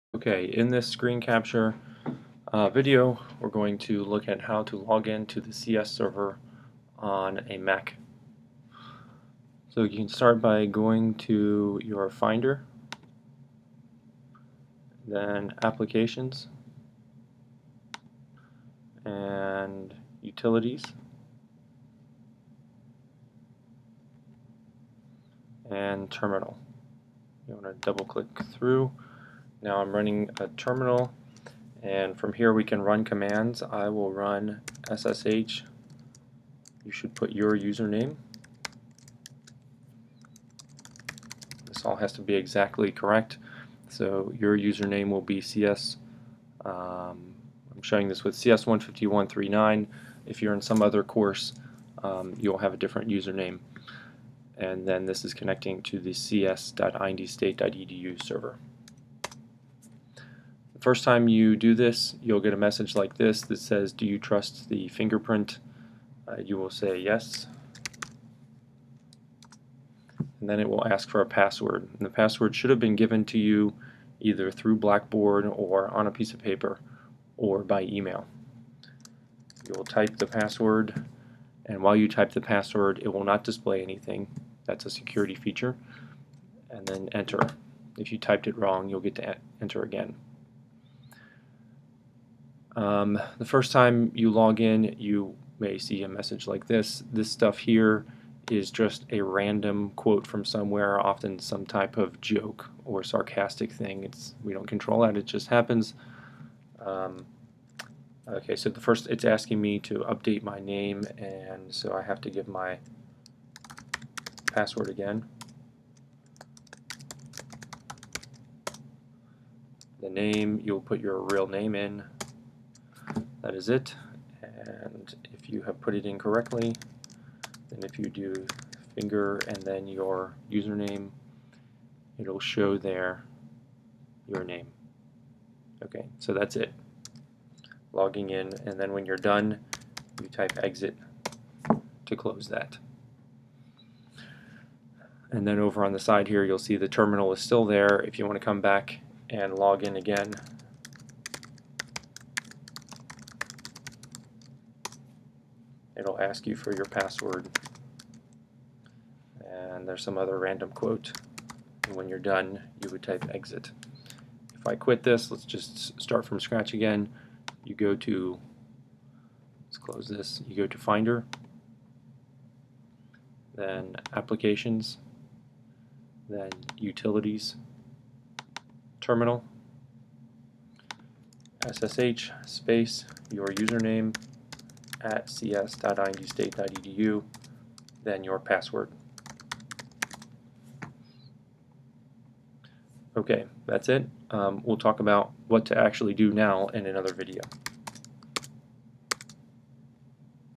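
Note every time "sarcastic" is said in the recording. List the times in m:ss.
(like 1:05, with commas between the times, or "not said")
1:43.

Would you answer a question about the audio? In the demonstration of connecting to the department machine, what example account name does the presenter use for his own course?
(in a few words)
CS15139.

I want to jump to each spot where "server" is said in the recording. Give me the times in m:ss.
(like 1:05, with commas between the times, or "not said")
0:05, 0:58.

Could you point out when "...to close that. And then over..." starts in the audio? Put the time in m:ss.
2:22.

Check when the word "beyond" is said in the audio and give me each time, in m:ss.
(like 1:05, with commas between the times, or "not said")
not said.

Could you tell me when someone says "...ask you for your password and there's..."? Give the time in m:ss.
2:36.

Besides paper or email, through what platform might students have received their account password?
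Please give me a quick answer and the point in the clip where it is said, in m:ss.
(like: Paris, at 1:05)
Blackboard, at 1:14.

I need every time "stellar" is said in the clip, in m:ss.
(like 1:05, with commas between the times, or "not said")
not said.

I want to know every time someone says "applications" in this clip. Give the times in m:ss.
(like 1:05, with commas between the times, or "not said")
0:15, 2:54.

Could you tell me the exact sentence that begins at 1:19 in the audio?
You'll type the password and while you type the password it will not display anything.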